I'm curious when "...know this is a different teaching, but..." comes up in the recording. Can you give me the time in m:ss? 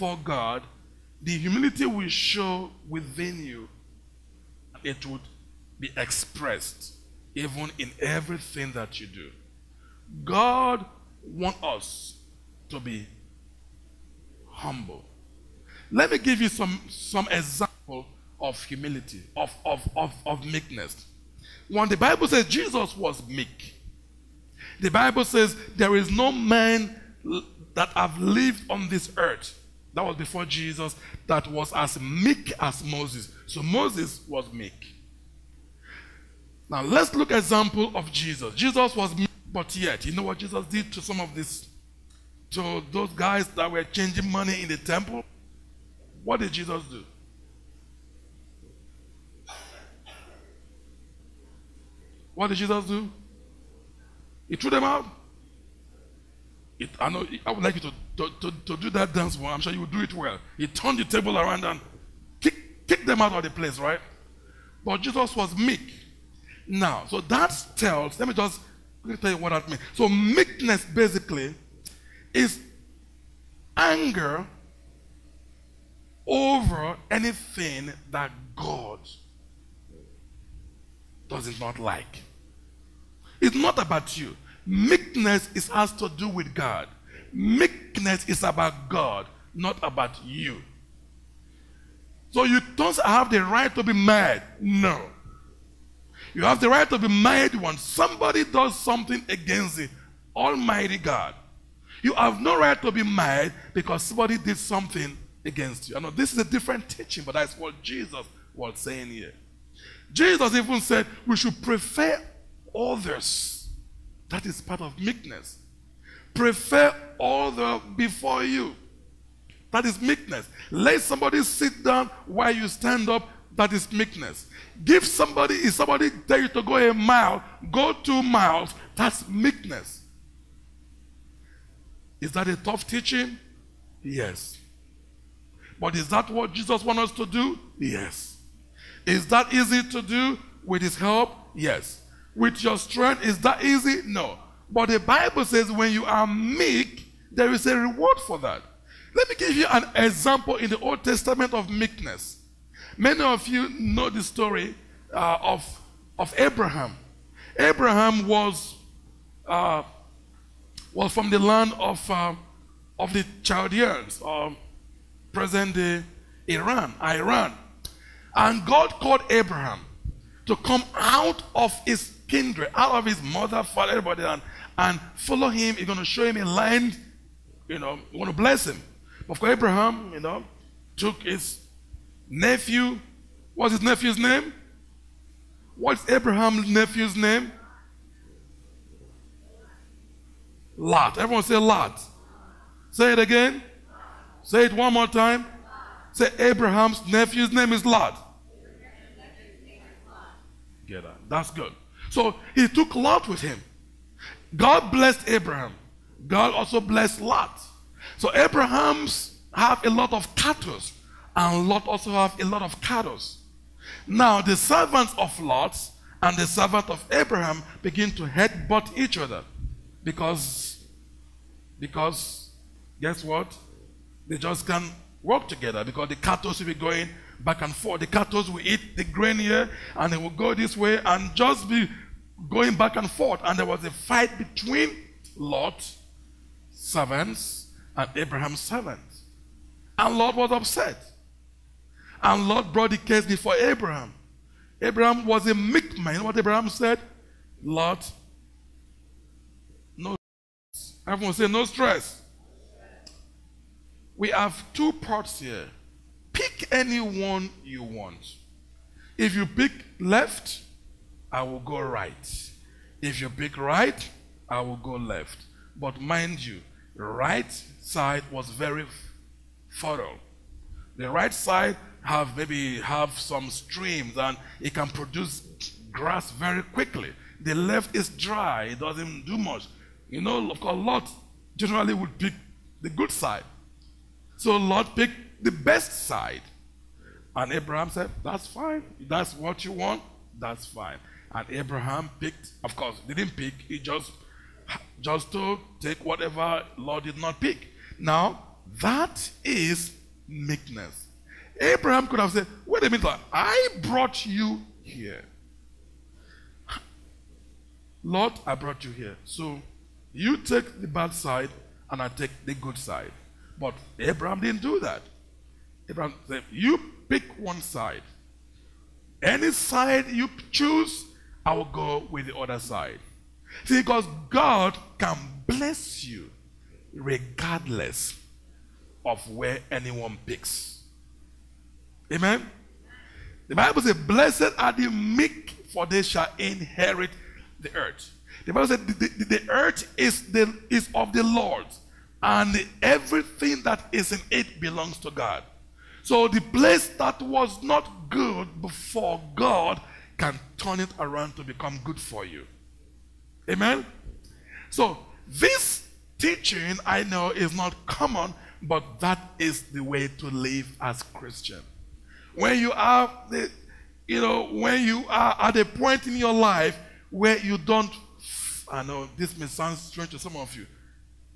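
1:45.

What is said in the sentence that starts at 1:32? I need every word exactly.
So you don't have the right to be mad.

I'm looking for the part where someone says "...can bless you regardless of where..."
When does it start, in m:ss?
5:24.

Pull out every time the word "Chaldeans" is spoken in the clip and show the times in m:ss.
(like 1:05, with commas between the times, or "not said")
2:43.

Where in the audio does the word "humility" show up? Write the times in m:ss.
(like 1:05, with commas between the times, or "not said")
0:01, 0:18.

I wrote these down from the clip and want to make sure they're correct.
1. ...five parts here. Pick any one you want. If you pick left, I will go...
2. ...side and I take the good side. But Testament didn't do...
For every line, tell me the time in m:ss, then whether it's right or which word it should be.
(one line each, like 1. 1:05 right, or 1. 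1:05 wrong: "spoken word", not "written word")
1. 4:14 wrong: "two", not "five"
2. 5:11 wrong: "Abraham", not "Testament".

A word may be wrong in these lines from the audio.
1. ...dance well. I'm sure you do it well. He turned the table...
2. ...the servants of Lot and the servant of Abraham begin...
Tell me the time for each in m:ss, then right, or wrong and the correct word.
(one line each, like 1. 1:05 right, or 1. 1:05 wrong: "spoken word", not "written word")
1. 0:59 right
2. 3:34 right.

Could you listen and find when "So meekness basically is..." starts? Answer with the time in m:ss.
1:09.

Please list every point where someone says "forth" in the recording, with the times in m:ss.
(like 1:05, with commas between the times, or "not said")
3:47, 3:53.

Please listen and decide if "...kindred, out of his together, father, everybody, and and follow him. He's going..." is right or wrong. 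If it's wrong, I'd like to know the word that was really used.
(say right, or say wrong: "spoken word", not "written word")
wrong: "mother", not "together".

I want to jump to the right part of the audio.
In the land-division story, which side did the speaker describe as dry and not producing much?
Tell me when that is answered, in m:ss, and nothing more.
4:37.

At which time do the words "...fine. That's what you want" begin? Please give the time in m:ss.
4:48.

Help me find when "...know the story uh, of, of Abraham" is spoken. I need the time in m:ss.
2:33.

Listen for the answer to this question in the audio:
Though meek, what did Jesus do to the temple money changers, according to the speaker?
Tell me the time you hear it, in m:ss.
0:54.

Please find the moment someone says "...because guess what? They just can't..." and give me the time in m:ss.
3:41.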